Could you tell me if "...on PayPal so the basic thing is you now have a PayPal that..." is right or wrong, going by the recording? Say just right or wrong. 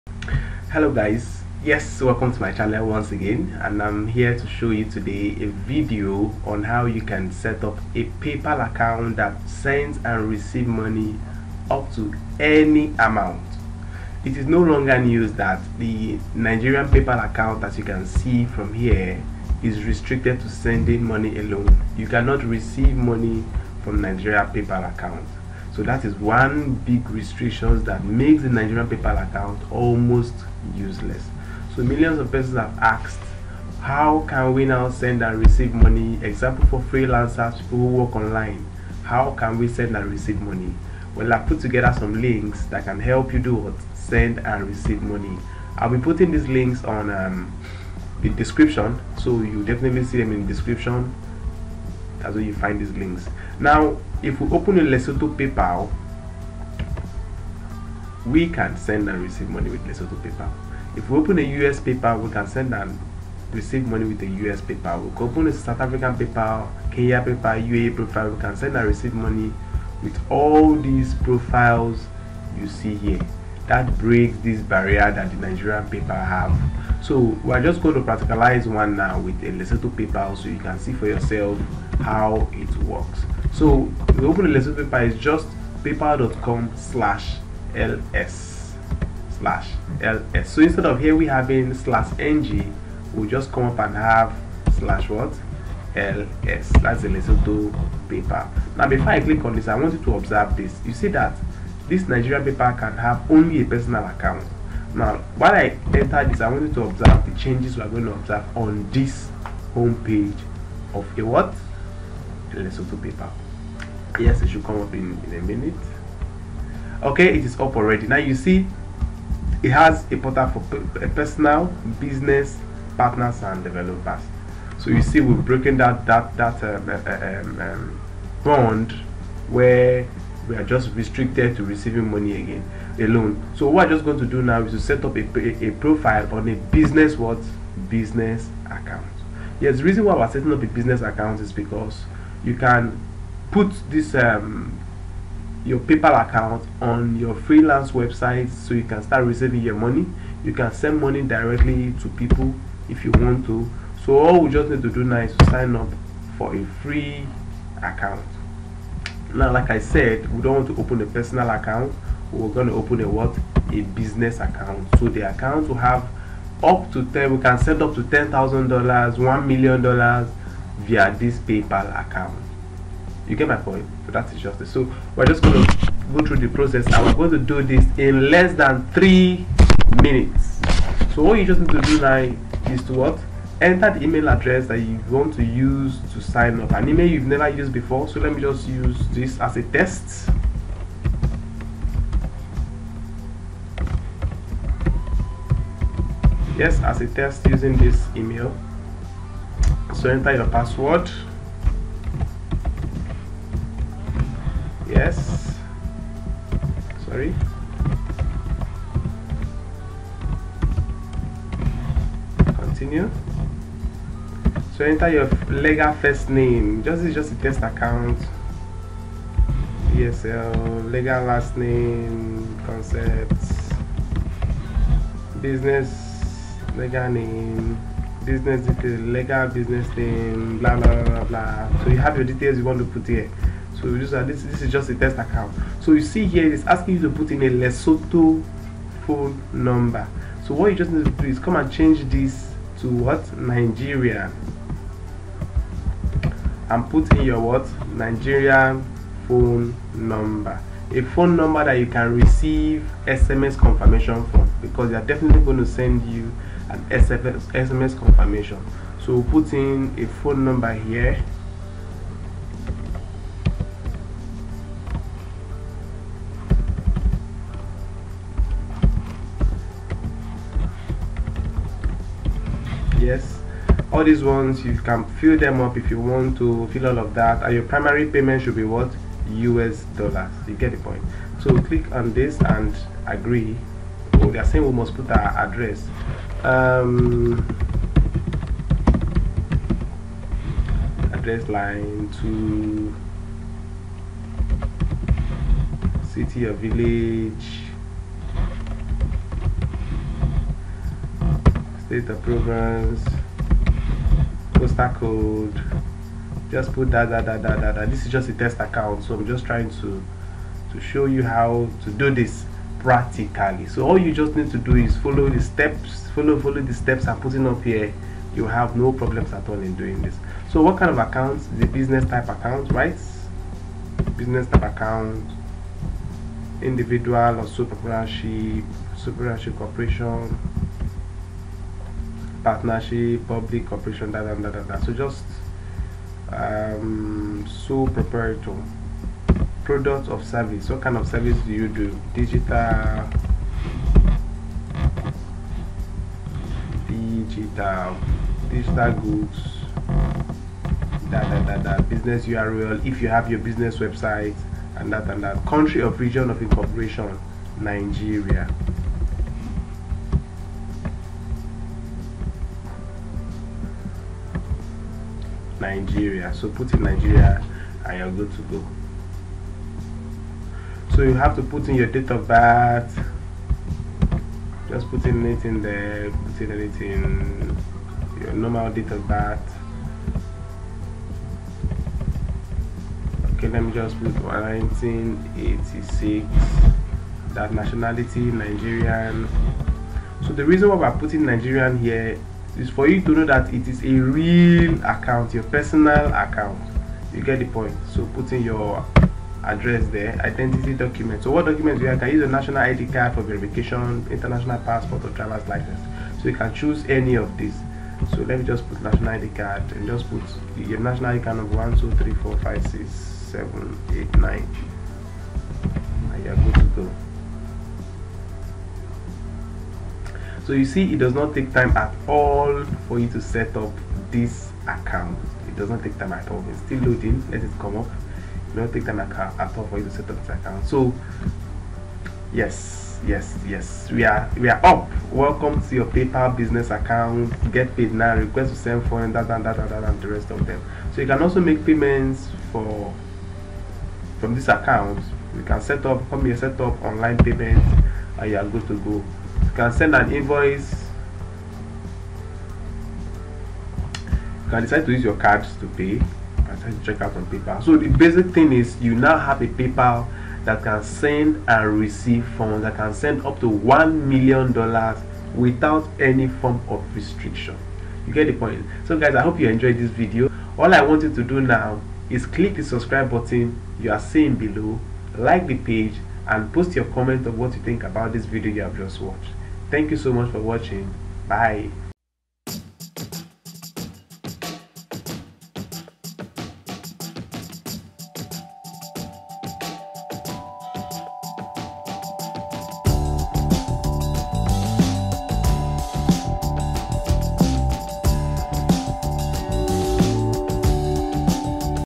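right.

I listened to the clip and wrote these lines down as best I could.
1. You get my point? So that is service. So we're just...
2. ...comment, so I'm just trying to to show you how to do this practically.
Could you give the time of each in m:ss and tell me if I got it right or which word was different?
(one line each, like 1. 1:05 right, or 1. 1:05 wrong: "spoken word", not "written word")
1. 2:53 wrong: "justice", not "service"
2. 5:08 wrong: "account", not "comment".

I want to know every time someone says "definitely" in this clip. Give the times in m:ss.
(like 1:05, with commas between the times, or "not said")
0:49, 4:15.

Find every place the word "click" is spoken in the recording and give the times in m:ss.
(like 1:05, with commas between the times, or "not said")
1:39, 4:41, 7:52.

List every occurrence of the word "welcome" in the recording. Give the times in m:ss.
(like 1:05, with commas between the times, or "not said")
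0:02, 7:15.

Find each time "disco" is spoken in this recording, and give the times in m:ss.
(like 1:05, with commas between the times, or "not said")
not said.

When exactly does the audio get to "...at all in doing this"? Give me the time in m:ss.
5:19.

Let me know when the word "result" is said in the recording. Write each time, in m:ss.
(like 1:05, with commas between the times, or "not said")
not said.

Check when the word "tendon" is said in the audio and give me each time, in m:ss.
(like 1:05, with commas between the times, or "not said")
not said.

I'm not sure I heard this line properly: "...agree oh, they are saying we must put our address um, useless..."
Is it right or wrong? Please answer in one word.
wrong.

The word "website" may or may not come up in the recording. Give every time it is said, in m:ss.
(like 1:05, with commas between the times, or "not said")
2:27, 5:53.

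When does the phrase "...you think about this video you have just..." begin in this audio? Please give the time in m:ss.
7:57.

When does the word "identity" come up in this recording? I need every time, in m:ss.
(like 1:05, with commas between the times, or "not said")
6:40.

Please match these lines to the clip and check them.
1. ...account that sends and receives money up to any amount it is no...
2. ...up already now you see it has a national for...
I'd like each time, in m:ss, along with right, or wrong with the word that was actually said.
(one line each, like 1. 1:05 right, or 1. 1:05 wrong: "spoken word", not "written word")
1. 0:08 right
2. 1:57 wrong: "portal", not "national".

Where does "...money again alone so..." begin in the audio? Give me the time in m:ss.
2:12.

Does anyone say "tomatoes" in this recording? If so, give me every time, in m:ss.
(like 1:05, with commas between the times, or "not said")
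not said.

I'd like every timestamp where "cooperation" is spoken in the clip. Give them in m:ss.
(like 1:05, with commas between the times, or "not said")
5:33.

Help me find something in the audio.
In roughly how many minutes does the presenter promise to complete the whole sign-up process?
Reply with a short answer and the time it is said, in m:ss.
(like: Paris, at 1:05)
3 minutes, at 2:58.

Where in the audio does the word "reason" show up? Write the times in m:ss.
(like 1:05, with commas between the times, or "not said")
2:19, 6:30.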